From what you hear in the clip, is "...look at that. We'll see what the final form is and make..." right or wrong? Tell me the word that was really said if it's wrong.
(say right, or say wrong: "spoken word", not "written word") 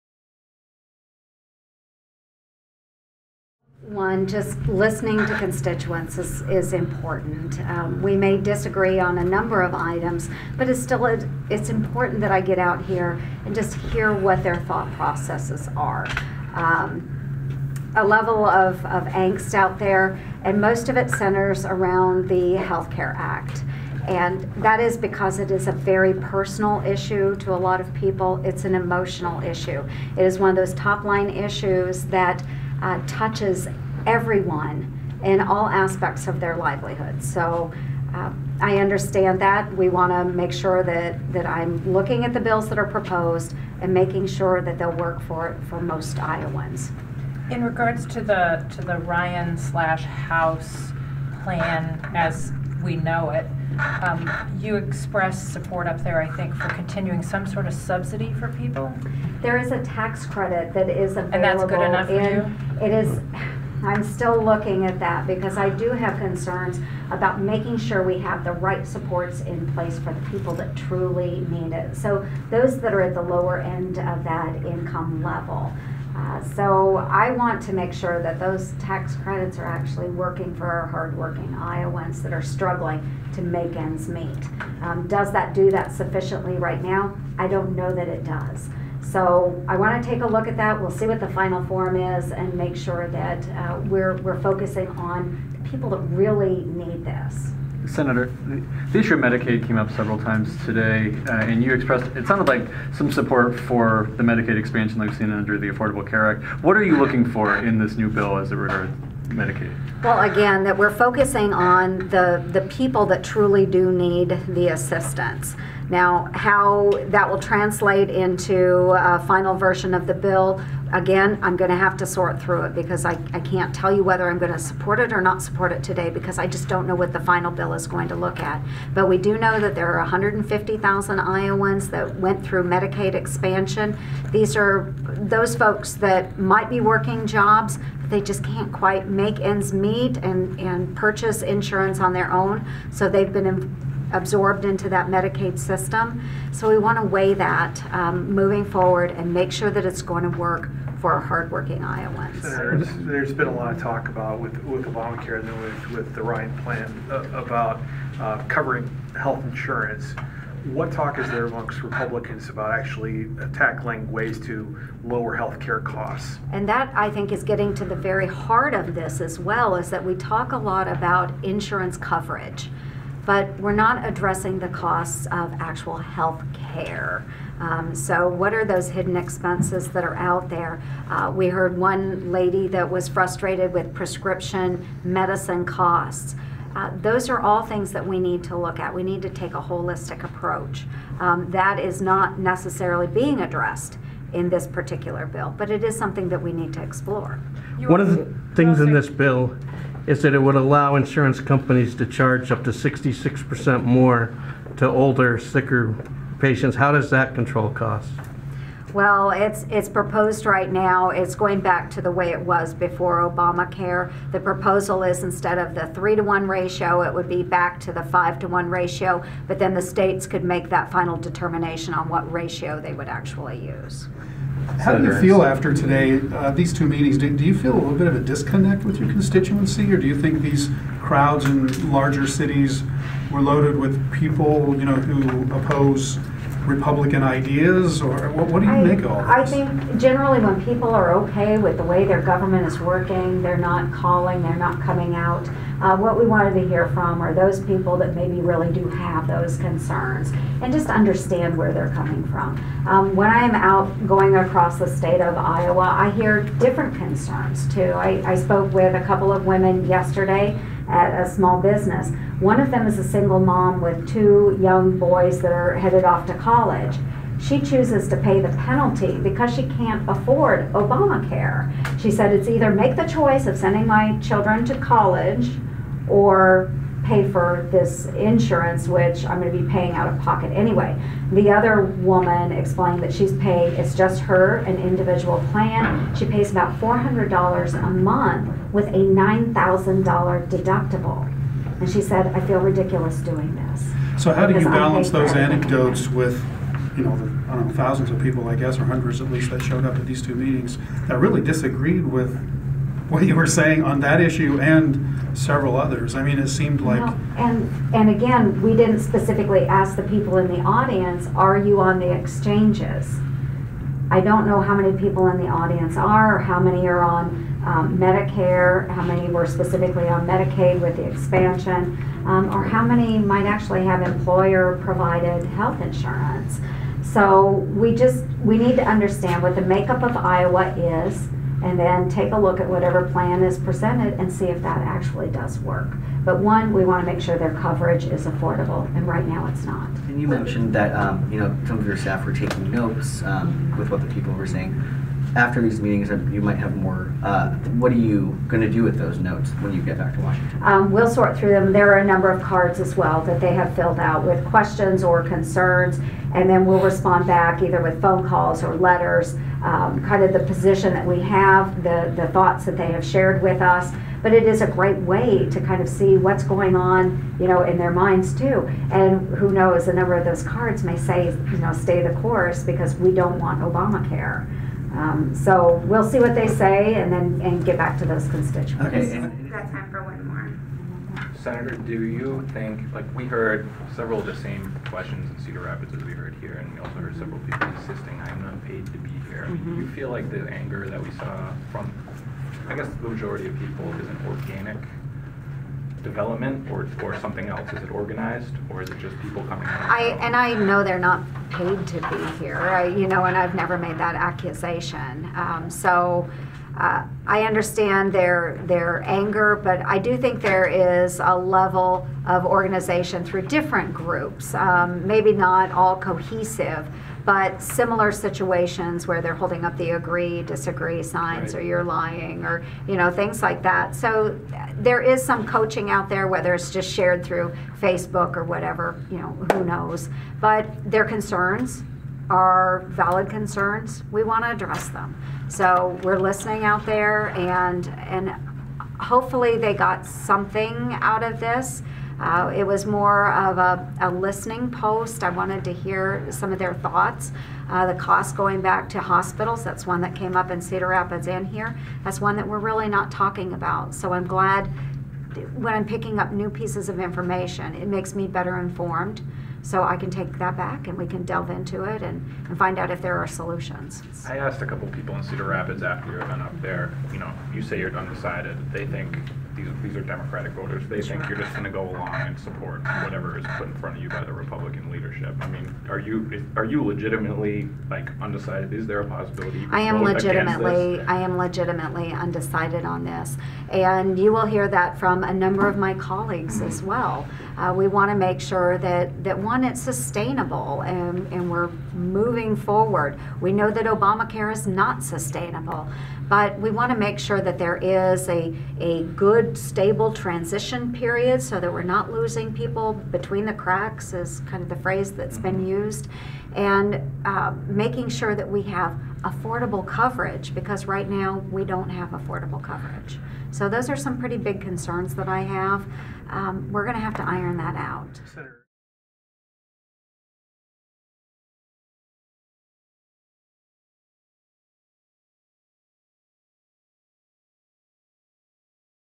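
right.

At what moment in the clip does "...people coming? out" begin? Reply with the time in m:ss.
6:39.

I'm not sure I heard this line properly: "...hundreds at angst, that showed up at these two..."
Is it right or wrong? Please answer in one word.
wrong.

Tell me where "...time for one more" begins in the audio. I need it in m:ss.
6:19.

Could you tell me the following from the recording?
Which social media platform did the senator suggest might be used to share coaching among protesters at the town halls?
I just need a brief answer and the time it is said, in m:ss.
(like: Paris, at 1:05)
Facebook, at 7:07.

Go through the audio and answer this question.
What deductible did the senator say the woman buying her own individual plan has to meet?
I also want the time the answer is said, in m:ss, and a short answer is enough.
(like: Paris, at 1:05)
$9,000, at 4:48.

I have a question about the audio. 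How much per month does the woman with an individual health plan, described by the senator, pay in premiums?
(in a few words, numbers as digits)
$400.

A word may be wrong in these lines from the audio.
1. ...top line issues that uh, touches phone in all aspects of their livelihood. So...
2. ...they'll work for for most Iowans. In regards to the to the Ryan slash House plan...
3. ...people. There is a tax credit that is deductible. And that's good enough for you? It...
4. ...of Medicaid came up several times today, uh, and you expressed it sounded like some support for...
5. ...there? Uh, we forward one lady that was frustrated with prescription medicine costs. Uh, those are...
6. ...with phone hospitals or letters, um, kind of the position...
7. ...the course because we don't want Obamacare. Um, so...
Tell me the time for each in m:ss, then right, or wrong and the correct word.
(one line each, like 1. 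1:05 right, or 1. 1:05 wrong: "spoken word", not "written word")
1. 0:30 wrong: "everyone", not "phone"
2. 0:44 right
3. 0:58 wrong: "available", not "deductible"
4. 1:39 right
5. 3:00 wrong: "heard", not "forward"
6. 5:57 wrong: "calls", not "hospitals"
7. 6:12 right.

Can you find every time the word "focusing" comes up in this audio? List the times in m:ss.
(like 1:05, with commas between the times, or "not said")
1:34, 1:50.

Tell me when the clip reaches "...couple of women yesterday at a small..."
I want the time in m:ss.
4:19.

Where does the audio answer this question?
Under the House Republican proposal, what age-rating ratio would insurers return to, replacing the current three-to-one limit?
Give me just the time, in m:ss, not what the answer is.
3:38.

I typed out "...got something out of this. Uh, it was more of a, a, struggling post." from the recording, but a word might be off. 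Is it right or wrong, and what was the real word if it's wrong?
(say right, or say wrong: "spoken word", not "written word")
wrong: "listening", not "struggling".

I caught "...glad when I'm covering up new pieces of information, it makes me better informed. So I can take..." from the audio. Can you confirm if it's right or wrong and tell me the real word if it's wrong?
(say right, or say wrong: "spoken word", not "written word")
wrong: "picking", not "covering".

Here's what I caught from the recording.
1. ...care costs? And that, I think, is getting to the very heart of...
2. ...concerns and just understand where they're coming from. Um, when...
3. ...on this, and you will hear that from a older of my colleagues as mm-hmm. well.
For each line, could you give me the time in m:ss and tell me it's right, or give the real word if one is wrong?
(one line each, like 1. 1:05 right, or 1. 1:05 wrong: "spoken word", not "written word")
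1. 2:45 right
2. 4:09 right
3. 8:02 wrong: "number", not "older".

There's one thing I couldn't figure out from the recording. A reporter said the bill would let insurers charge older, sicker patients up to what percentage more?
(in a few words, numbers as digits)
66%.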